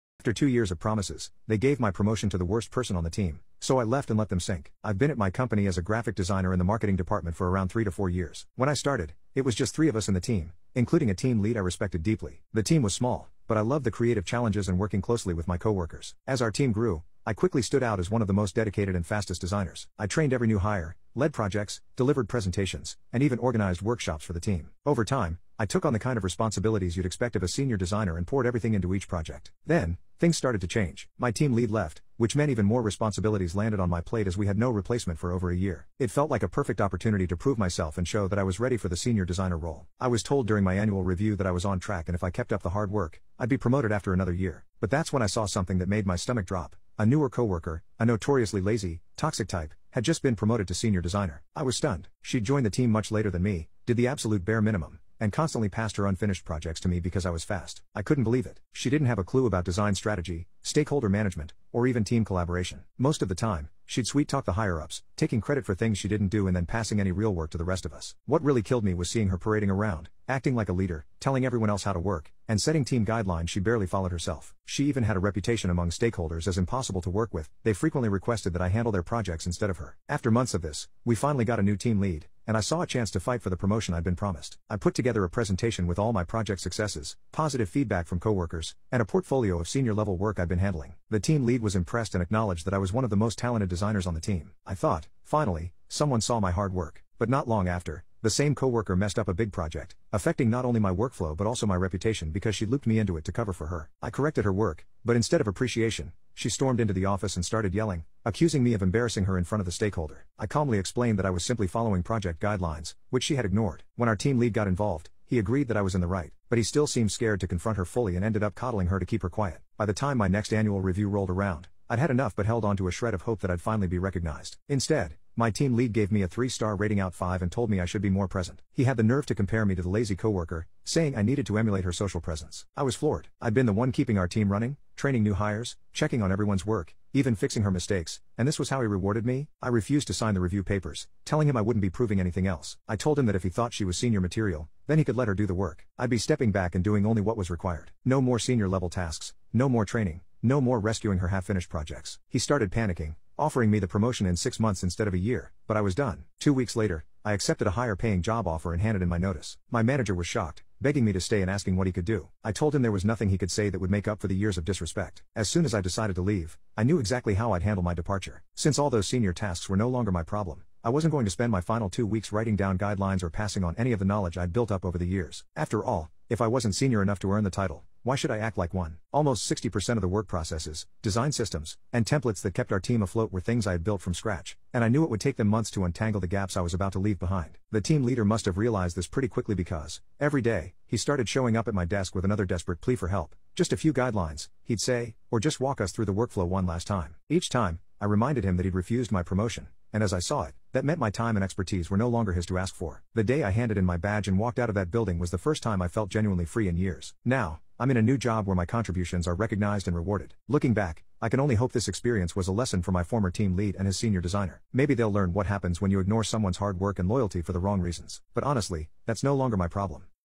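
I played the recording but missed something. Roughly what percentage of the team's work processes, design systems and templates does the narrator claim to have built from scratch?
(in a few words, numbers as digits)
60%.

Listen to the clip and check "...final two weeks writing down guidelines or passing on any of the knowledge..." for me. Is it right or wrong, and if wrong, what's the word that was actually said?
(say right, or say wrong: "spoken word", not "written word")
right.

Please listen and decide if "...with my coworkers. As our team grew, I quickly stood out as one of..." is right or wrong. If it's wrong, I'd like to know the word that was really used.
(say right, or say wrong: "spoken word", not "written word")
right.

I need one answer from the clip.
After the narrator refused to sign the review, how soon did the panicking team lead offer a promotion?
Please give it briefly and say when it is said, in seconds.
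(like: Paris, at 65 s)
6 months, at 154 s.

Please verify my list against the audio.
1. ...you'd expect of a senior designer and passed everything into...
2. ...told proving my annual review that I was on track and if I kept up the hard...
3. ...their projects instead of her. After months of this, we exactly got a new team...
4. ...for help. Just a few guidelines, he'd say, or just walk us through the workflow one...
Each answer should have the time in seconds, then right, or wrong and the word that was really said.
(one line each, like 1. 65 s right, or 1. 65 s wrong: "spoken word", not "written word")
1. 26 s wrong: "poured", not "passed"
2. 40 s wrong: "during", not "proving"
3. 78 s wrong: "finally", not "exactly"
4. 192 s right.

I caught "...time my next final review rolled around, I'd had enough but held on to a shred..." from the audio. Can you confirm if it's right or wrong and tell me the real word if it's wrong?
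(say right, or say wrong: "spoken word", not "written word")
wrong: "annual", not "final".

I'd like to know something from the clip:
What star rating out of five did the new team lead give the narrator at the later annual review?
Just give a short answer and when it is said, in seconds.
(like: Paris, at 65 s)
3, at 126 s.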